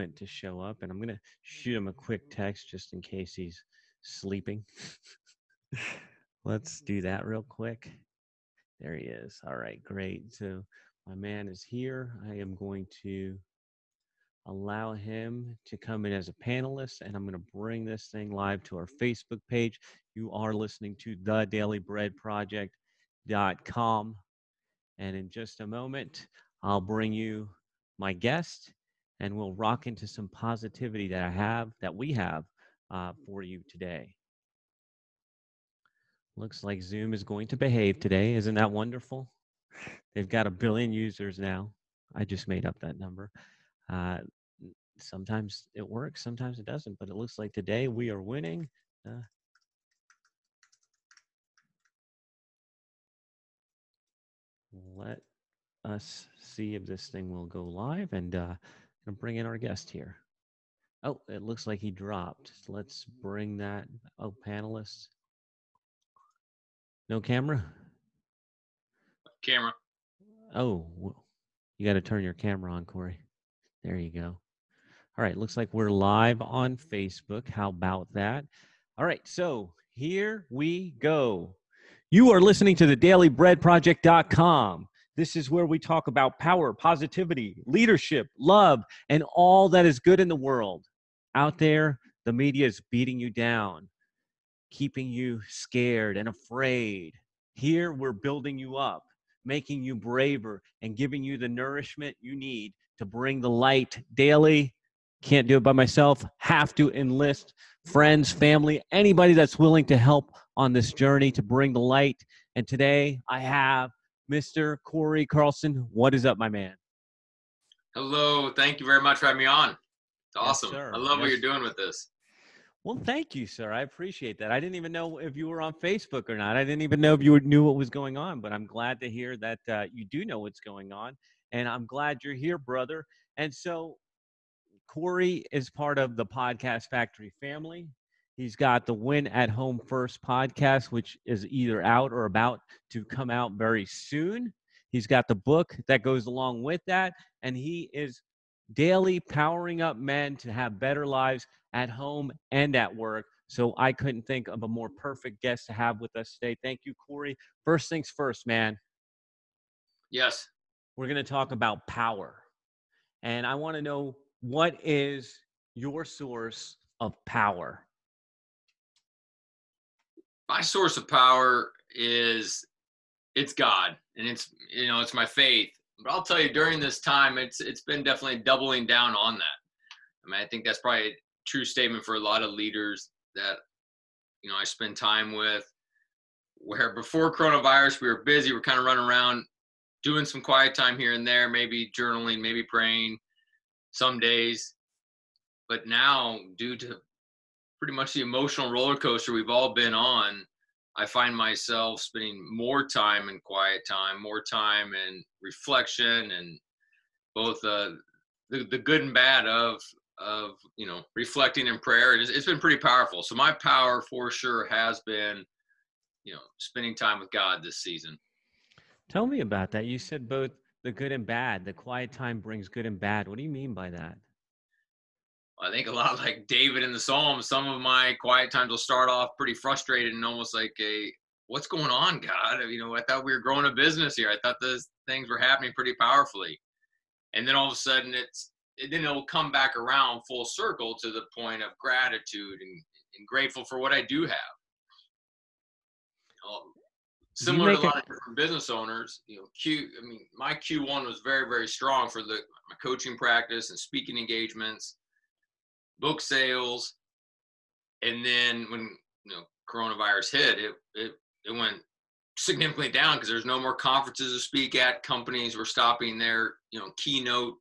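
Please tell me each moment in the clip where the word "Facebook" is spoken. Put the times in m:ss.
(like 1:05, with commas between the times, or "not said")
0:18, 1:16, 2:05.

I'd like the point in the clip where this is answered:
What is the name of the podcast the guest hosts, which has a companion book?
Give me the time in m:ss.
2:18.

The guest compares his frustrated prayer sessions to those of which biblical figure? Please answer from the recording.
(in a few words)
David.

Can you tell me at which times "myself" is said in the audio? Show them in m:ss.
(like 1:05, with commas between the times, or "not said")
1:45, 3:21.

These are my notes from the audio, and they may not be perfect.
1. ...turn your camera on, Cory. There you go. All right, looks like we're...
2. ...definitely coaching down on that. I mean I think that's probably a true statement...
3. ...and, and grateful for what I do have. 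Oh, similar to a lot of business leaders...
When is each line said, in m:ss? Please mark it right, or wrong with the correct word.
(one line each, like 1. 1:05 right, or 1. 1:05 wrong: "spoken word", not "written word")
1. 1:12 right
2. 2:58 wrong: "doubling", not "coaching"
3. 4:02 wrong: "owners", not "leaders".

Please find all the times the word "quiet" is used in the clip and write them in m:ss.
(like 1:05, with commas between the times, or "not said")
3:10, 3:23, 3:41, 3:48.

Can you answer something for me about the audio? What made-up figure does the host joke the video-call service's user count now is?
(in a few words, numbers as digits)
a billion.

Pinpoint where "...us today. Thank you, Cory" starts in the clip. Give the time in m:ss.
2:36.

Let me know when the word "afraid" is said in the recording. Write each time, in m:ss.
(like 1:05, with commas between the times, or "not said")
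1:36.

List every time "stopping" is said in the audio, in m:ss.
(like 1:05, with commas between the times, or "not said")
4:25.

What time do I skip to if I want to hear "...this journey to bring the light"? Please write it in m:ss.
1:50.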